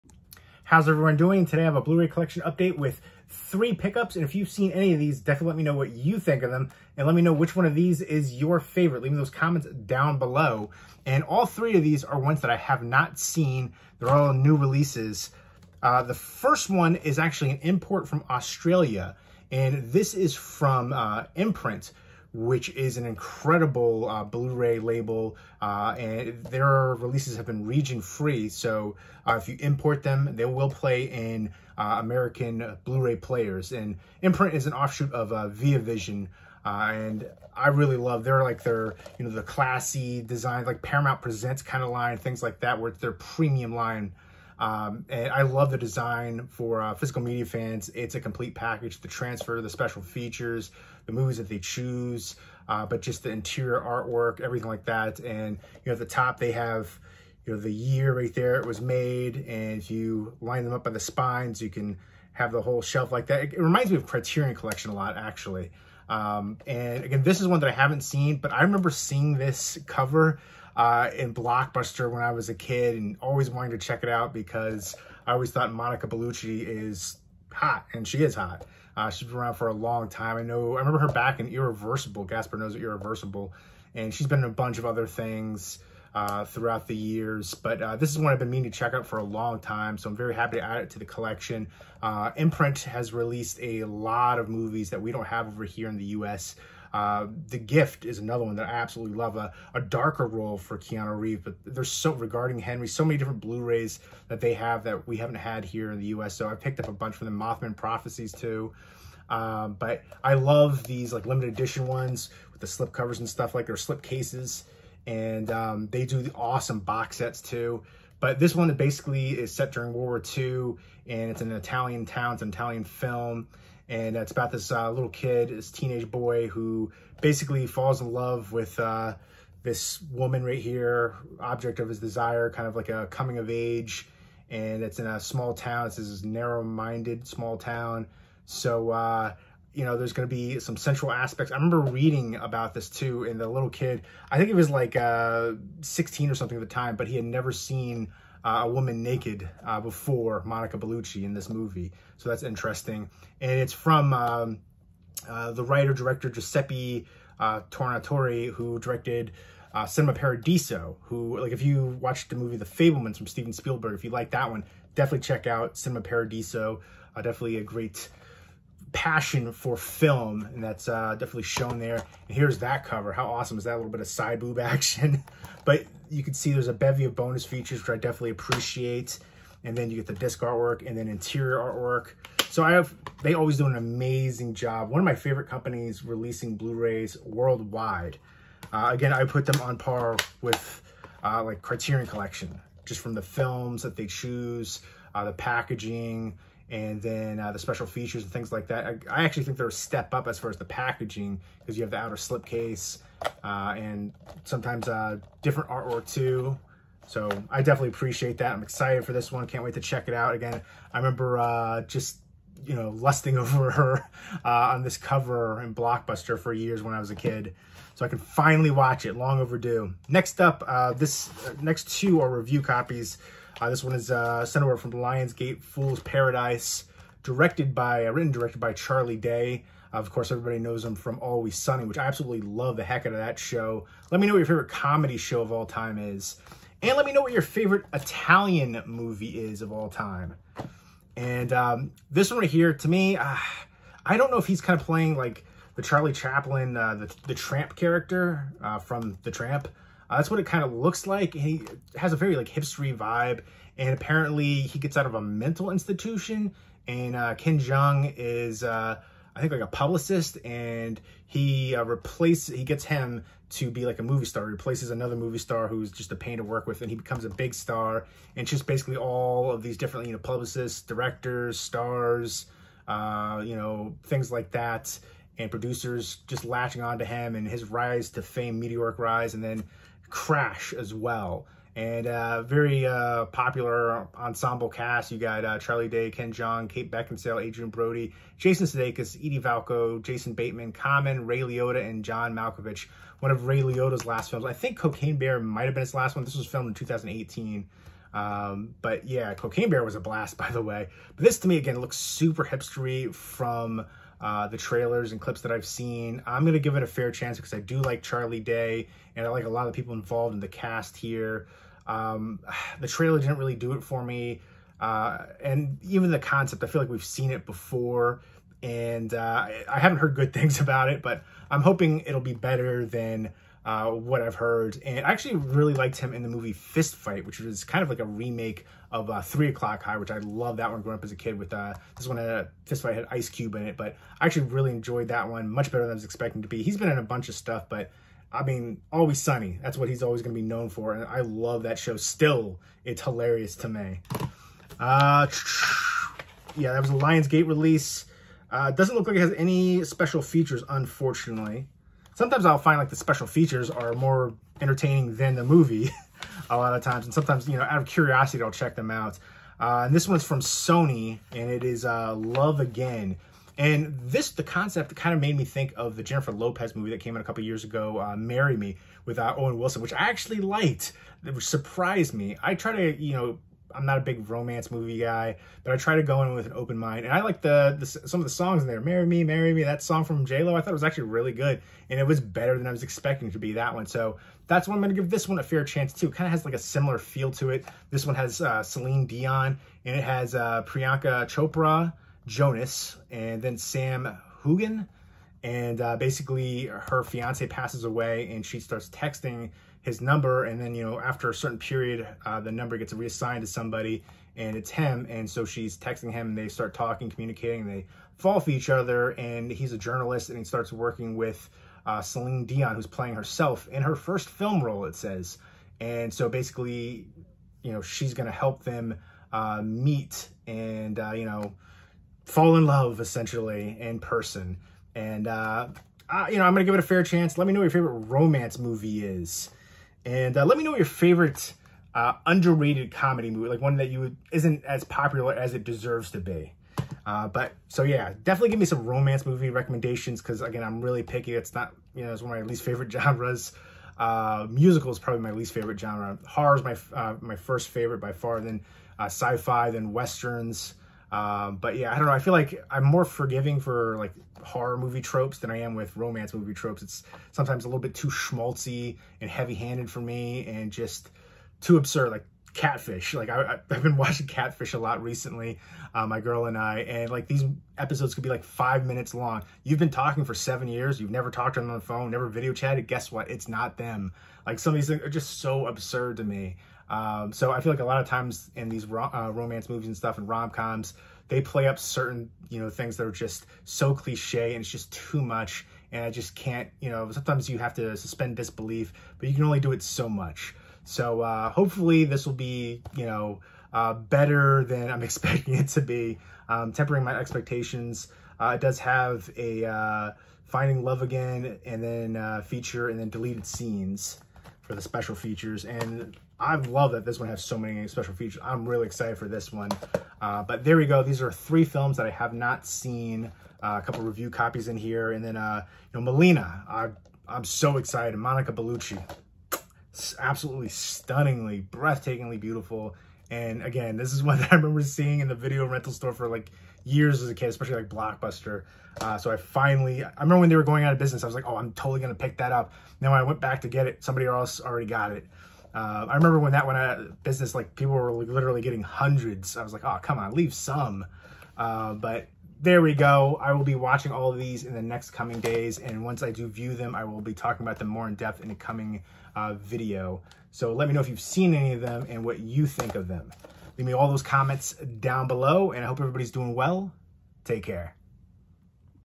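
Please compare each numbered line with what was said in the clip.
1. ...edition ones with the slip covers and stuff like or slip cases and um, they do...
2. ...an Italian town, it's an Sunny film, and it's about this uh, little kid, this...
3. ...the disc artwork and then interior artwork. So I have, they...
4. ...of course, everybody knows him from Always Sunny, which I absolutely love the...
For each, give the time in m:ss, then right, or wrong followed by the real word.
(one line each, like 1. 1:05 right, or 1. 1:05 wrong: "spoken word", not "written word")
1. 1:51 right
2. 2:01 wrong: "Italian", not "Sunny"
3. 3:00 right
4. 3:49 right.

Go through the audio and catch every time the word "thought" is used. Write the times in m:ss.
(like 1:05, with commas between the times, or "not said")
1:15, 6:20.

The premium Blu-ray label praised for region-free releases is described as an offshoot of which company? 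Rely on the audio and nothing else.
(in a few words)
ViaVision.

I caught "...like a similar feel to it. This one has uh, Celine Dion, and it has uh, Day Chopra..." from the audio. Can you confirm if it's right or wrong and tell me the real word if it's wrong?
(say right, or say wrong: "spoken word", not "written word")
wrong: "Priyanka", not "Day".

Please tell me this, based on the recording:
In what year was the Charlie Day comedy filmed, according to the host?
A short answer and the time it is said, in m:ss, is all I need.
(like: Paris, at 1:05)
2018, at 4:56.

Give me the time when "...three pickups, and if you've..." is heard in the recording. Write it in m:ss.
0:03.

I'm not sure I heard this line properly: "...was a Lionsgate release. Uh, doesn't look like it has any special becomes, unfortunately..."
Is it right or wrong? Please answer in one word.
wrong.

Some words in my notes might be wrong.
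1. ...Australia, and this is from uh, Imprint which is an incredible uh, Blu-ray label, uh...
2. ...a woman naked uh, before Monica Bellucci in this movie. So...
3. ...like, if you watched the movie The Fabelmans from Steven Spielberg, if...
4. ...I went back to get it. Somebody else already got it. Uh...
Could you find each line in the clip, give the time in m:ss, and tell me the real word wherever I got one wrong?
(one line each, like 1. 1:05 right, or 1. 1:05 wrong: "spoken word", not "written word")
1. 0:18 right
2. 2:28 right
3. 2:41 right
4. 8:53 right.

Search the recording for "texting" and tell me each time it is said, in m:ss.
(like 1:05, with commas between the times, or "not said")
6:38, 6:45.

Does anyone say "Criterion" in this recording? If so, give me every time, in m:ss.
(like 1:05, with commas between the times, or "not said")
1:04, 3:11.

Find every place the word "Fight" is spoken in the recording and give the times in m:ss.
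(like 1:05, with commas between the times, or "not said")
5:26, 5:32.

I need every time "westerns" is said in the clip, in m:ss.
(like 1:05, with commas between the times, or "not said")
7:29.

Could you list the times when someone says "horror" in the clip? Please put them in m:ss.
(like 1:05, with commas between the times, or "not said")
7:26, 7:34.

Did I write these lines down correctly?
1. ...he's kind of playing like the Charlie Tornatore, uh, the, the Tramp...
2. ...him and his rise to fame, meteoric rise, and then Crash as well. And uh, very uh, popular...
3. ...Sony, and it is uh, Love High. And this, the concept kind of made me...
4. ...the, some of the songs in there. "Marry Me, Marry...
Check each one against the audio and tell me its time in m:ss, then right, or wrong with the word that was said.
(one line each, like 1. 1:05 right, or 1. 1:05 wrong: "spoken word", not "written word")
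1. 4:04 wrong: "Chaplin", not "Tornatore"
2. 4:37 right
3. 6:00 wrong: "Again", not "High"
4. 6:17 right.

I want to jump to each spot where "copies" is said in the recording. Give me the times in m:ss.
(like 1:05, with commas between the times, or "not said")
3:42, 8:34.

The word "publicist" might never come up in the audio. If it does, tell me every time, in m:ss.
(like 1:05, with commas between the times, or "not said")
4:19, 4:30.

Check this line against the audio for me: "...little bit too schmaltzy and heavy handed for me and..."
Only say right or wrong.
right.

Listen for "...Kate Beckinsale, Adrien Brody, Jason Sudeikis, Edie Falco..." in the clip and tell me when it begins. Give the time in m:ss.
4:46.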